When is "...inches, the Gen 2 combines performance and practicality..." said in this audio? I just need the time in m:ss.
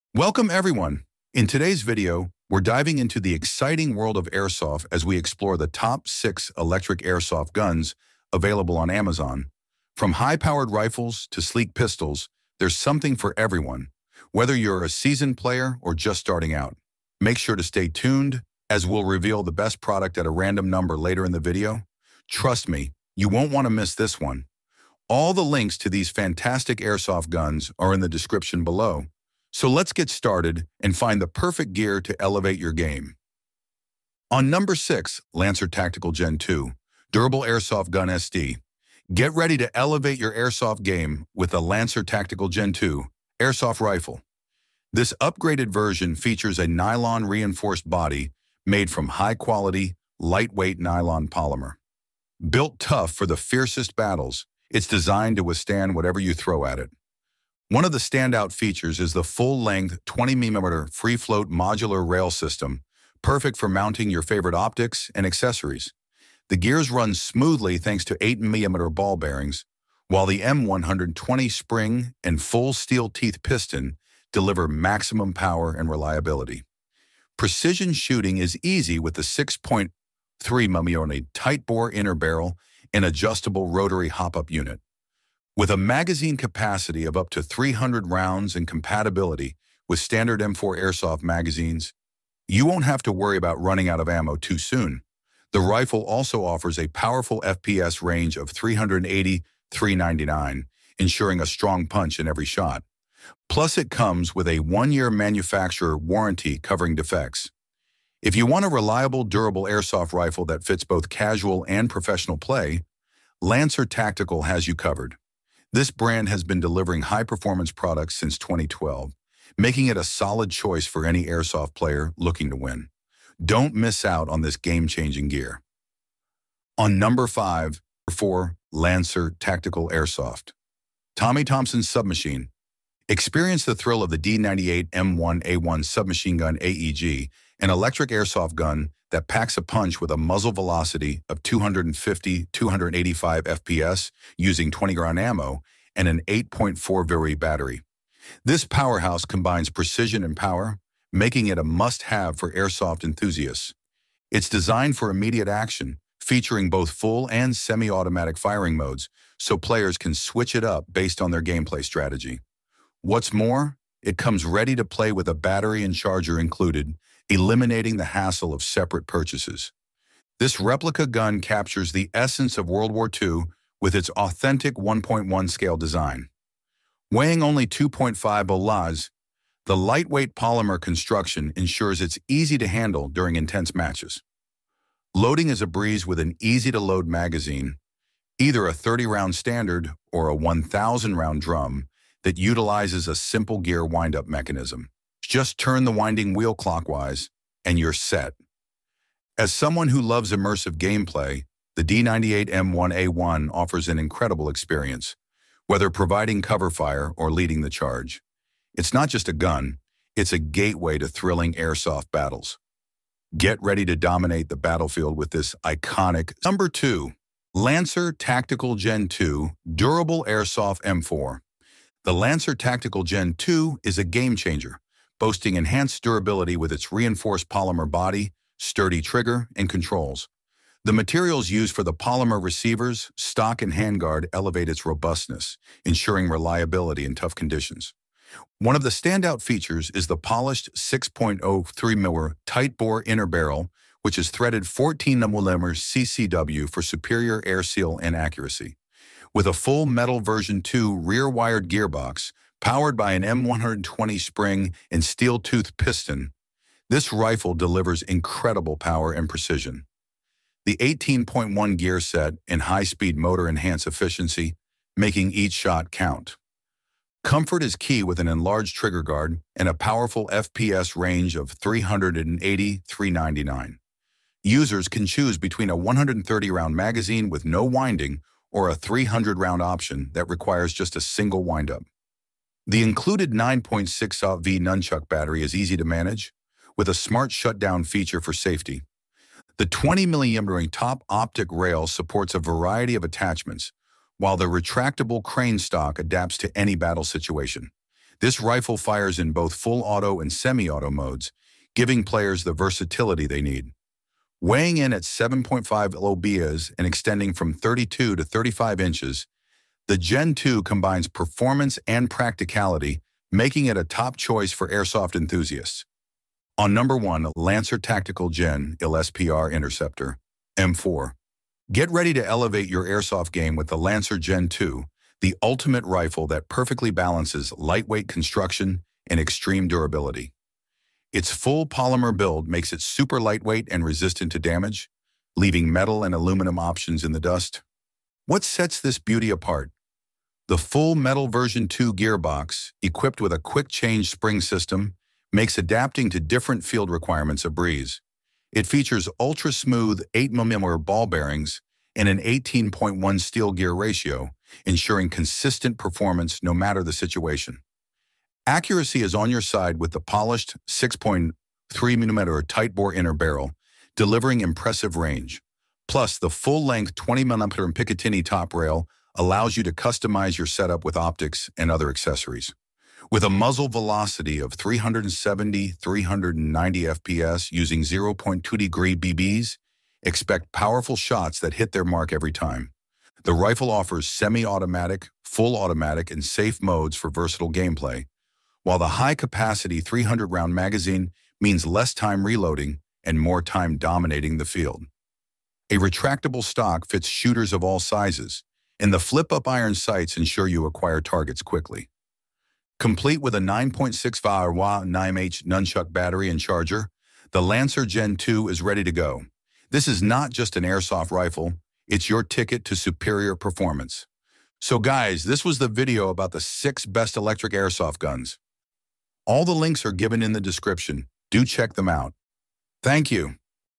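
5:08.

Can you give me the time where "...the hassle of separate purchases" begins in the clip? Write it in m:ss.
2:47.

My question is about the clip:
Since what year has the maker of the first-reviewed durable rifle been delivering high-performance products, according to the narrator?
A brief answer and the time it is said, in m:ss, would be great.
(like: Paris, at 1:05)
2012, at 1:58.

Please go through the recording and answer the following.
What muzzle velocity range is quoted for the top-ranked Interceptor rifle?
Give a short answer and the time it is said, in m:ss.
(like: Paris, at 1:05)
370-390 FPS, at 6:14.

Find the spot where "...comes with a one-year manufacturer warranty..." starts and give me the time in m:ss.
1:43.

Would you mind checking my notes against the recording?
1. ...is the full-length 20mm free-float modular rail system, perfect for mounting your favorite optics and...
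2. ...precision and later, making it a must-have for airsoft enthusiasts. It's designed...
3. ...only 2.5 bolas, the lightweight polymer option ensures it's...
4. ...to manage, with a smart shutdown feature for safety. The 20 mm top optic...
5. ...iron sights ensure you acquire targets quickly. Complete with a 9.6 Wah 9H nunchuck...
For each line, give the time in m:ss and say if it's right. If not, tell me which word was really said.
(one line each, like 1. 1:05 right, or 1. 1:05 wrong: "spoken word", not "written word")
1. 0:58 right
2. 2:29 wrong: "power", not "later"
3. 2:57 wrong: "construction", not "option"
4. 4:45 right
5. 6:39 right.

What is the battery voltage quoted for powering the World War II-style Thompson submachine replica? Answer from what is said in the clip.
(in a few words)
8.4 V.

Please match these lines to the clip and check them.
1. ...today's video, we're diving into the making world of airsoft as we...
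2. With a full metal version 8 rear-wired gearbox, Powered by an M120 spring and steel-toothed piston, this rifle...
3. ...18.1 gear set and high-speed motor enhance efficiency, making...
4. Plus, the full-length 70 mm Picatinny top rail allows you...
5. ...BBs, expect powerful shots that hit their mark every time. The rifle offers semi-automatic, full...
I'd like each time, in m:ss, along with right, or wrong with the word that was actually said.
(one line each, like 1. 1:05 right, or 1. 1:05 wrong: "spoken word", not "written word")
1. 0:01 wrong: "exciting", not "making"
2. 4:09 wrong: "2", not "8"
3. 4:20 right
4. 6:05 wrong: "20", not "70"
5. 6:18 right.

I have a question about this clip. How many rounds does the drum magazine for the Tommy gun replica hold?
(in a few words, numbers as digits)
1,000.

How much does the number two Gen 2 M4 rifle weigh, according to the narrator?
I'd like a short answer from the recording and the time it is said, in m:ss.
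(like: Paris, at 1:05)
7.5 pounds, at 5:05.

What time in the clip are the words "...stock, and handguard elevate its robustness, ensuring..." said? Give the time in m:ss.
3:53.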